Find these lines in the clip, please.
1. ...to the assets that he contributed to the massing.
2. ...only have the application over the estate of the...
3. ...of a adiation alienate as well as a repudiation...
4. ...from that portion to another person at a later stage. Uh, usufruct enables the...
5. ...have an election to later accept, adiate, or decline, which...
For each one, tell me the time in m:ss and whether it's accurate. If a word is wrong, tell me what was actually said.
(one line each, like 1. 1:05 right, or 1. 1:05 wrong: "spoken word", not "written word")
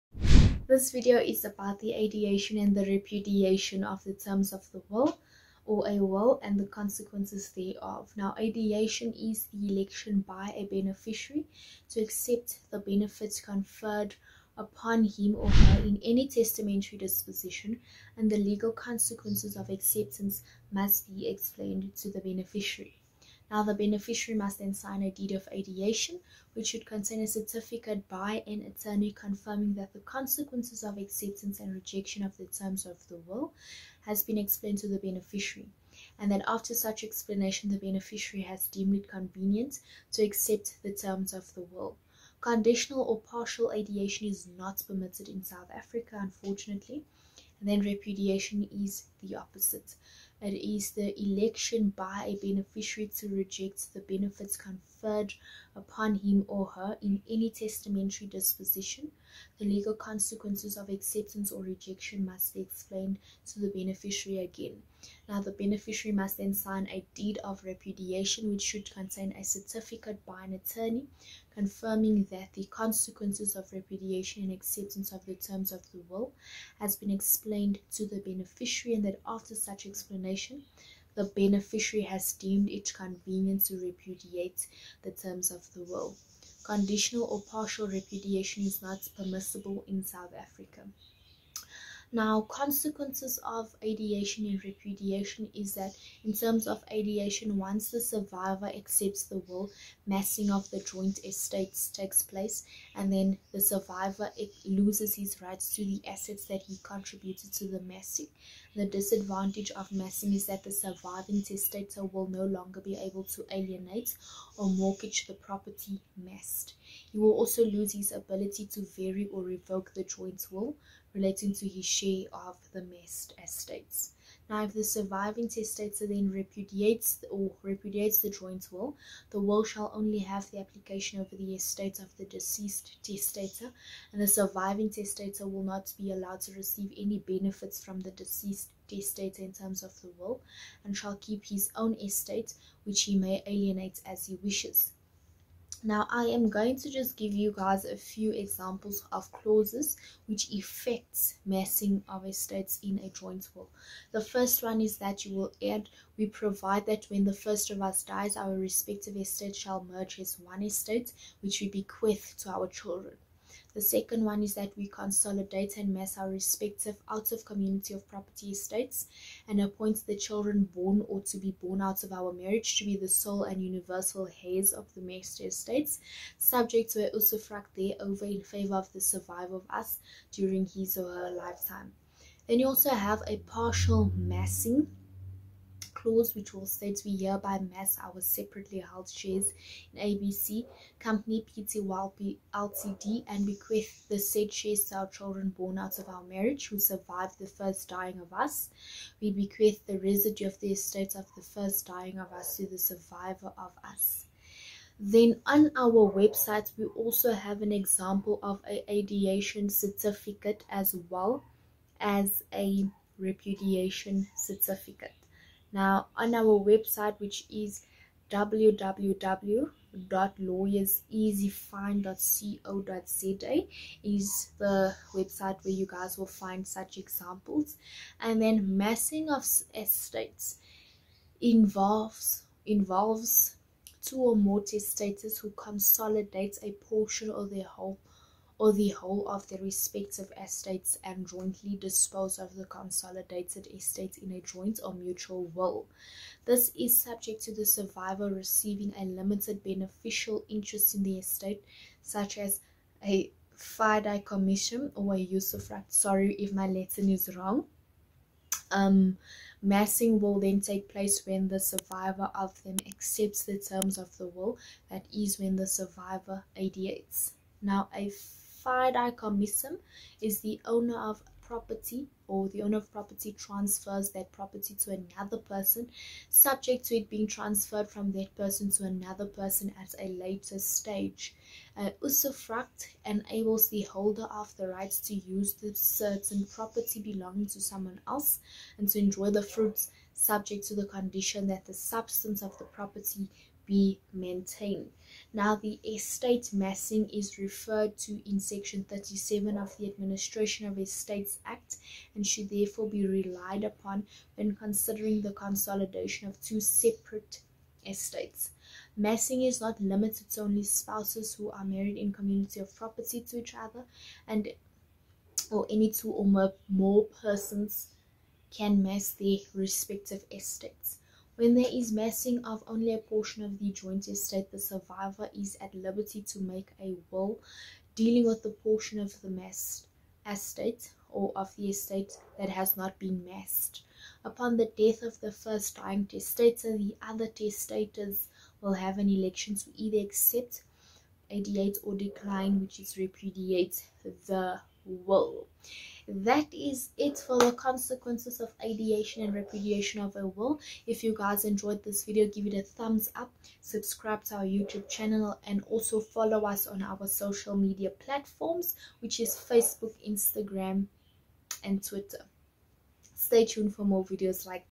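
1. 1:45 right
2. 2:09 right
3. 3:28 wrong: "certificate", not "alienate"
4. 4:37 wrong: "person", not "portion"
5. 5:38 wrong: "either", not "later".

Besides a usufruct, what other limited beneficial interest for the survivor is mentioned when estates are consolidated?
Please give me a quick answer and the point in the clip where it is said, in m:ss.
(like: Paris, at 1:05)
commission, at 4:14.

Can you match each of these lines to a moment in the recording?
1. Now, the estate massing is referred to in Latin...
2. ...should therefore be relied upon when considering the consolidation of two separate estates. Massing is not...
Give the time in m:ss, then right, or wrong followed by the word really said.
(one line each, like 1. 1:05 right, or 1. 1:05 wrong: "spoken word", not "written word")
1. 4:55 wrong: "Section", not "Latin"
2. 5:02 right.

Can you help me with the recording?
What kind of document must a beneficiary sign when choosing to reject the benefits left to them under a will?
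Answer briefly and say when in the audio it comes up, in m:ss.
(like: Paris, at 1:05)
deed of repudiation, at 1:07.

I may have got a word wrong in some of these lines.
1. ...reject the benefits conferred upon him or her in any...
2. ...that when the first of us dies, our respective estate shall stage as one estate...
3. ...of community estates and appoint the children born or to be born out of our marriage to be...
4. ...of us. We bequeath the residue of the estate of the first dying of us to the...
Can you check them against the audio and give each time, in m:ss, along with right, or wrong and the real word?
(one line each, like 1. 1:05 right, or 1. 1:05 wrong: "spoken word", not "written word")
1. 0:53 right
2. 2:36 wrong: "merge", not "stage"
3. 2:47 wrong: "property", not "community"
4. 3:18 right.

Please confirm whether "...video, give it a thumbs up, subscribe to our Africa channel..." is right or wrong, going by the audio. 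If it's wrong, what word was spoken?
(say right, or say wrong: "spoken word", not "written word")
wrong: "YouTube", not "Africa".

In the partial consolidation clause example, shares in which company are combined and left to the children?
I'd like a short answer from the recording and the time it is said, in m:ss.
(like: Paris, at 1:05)
ABC Company Pty Ltd, at 3:10.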